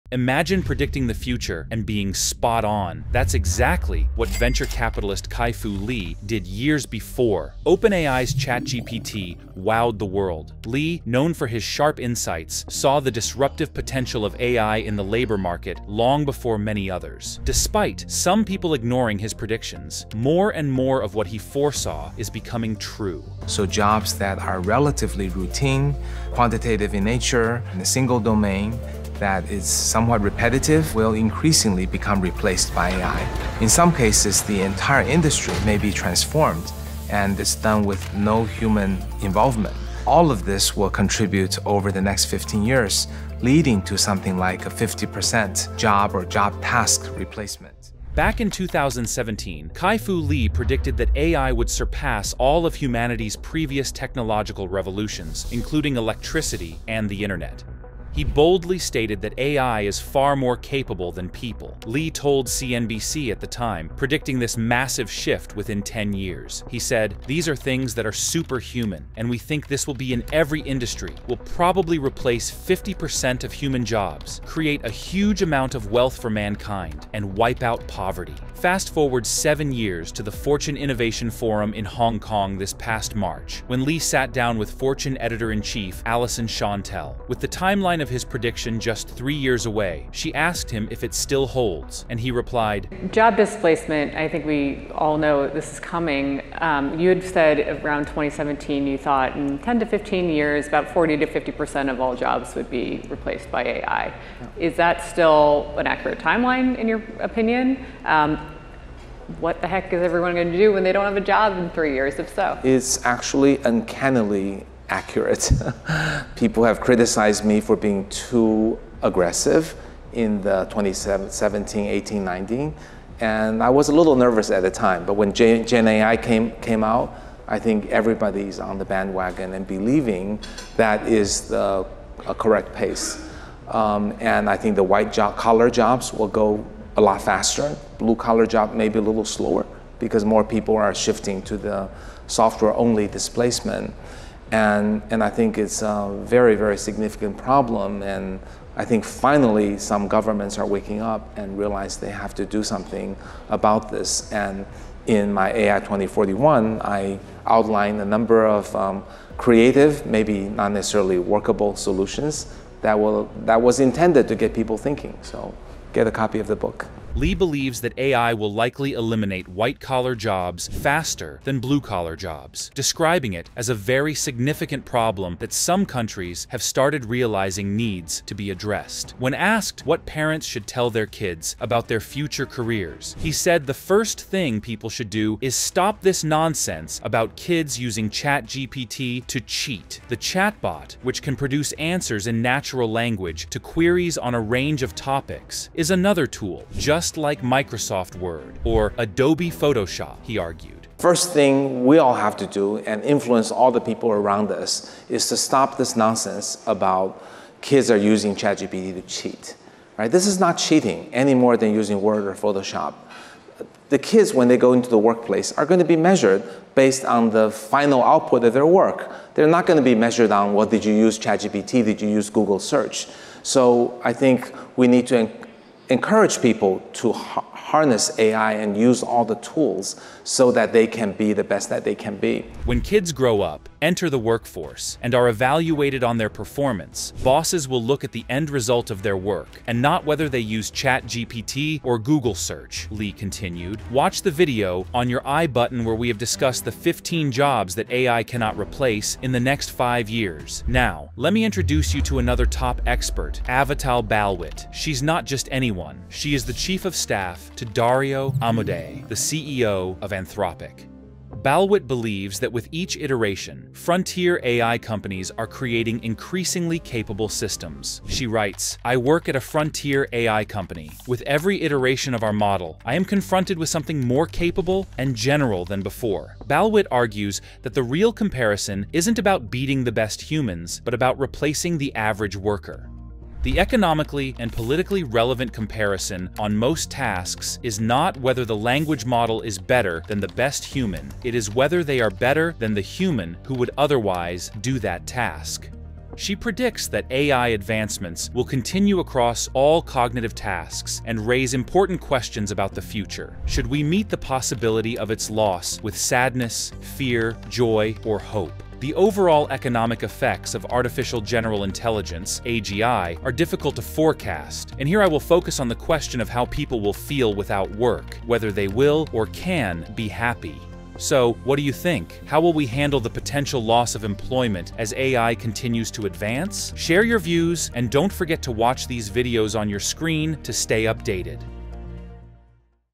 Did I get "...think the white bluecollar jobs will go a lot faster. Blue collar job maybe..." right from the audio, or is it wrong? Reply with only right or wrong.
wrong.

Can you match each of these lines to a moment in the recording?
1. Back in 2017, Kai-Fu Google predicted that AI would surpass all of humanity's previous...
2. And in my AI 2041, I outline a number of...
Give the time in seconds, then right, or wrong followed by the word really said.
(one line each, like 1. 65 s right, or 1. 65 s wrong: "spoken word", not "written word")
1. 48 s wrong: "Lee", not "Google"
2. 154 s right.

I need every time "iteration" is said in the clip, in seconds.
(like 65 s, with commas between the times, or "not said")
262 s, 271 s.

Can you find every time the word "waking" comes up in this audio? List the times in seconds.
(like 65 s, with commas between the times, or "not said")
150 s.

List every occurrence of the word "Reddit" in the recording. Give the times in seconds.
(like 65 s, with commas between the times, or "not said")
not said.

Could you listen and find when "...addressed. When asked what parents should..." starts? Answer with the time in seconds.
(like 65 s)
178 s.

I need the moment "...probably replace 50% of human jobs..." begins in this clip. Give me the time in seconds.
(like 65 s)
71 s.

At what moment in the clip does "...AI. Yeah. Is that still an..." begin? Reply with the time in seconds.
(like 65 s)
103 s.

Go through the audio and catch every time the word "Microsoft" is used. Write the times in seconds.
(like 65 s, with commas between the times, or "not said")
197 s.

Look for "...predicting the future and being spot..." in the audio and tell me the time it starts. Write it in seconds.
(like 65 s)
0 s.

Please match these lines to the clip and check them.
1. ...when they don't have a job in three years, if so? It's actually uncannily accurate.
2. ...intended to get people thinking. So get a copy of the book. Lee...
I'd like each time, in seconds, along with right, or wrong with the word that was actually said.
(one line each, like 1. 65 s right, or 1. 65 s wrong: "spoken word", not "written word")
1. 110 s right
2. 163 s right.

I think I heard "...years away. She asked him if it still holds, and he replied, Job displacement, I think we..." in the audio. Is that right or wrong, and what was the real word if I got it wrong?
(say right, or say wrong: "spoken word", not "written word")
right.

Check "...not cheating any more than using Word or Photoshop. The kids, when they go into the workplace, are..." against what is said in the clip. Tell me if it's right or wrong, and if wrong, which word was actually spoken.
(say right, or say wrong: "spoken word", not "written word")
right.